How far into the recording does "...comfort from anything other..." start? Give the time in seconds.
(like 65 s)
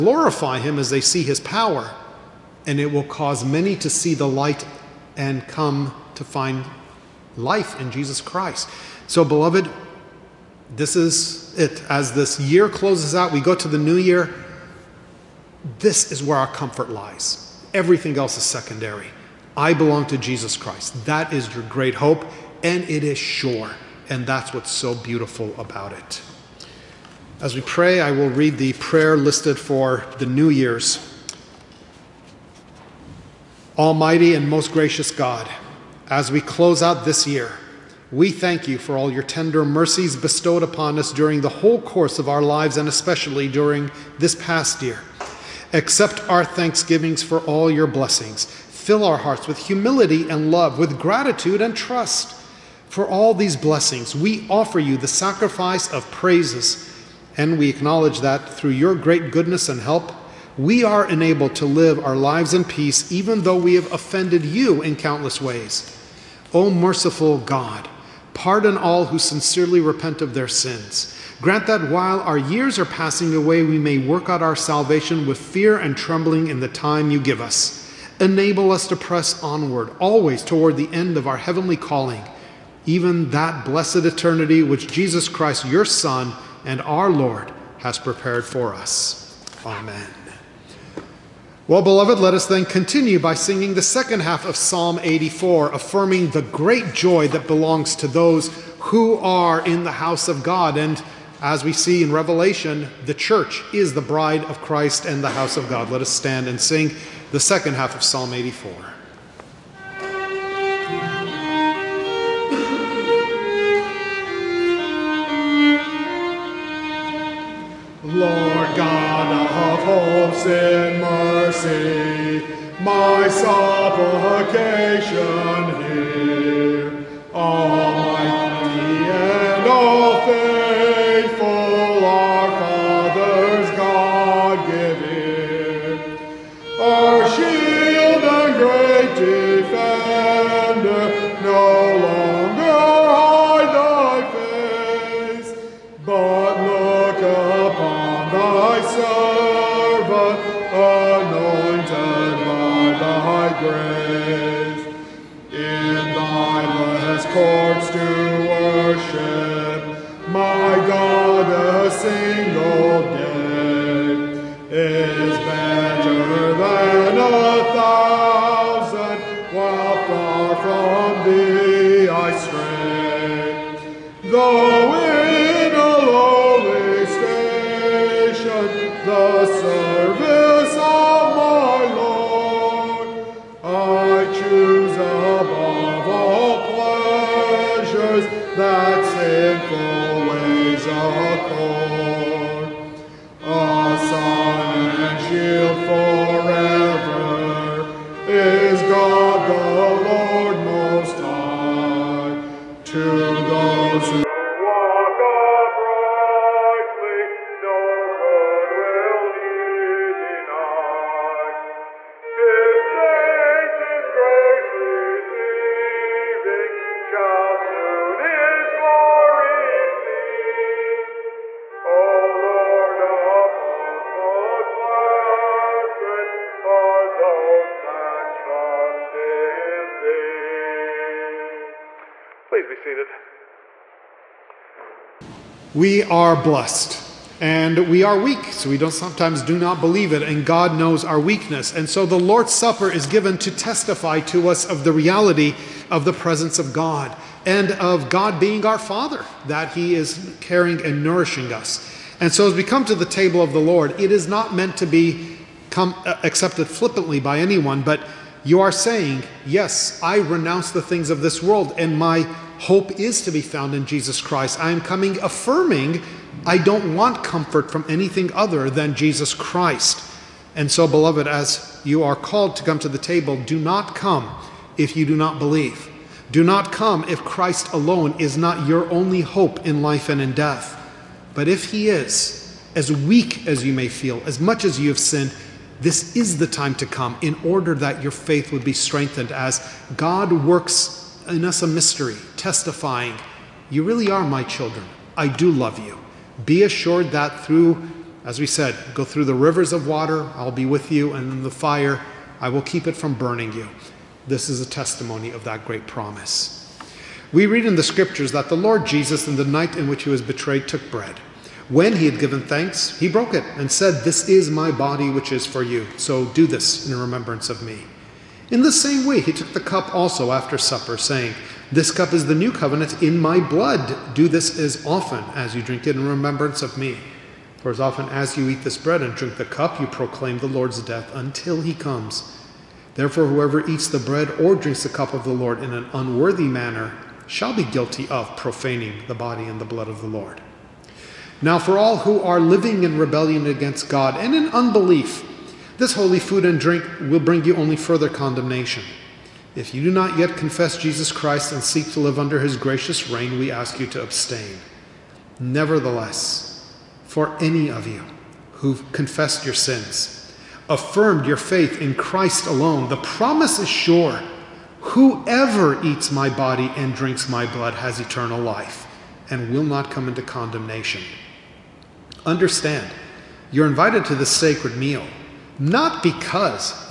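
267 s.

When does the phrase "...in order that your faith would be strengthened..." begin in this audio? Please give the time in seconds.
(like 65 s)
287 s.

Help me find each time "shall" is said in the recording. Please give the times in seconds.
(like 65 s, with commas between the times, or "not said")
337 s.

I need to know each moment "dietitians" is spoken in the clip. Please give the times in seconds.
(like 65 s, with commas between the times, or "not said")
not said.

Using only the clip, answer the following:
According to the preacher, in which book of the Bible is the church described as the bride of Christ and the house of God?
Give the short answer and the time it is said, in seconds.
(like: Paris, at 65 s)
Revelation, at 102 s.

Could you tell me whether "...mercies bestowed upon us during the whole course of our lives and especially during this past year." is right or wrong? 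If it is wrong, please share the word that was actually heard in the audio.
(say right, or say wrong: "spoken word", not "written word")
right.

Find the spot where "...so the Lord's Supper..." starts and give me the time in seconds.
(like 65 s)
241 s.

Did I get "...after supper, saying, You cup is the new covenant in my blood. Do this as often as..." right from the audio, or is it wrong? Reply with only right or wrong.
wrong.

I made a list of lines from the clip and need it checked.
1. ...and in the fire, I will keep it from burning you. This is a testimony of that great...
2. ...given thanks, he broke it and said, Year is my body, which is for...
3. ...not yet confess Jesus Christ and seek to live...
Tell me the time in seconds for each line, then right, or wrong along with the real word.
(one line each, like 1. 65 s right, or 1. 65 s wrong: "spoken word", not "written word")
1. 301 s right
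2. 312 s wrong: "This", not "Year"
3. 349 s right.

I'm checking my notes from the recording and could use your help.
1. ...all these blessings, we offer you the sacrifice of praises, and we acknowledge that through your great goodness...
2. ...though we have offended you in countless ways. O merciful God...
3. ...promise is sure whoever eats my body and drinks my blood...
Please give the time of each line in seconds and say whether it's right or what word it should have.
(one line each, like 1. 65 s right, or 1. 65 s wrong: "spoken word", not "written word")
1. 53 s right
2. 63 s right
3. 362 s right.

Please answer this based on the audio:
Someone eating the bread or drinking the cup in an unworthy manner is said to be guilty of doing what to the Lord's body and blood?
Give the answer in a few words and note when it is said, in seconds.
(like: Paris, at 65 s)
profaning, at 338 s.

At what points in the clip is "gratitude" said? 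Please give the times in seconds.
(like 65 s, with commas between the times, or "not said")
50 s.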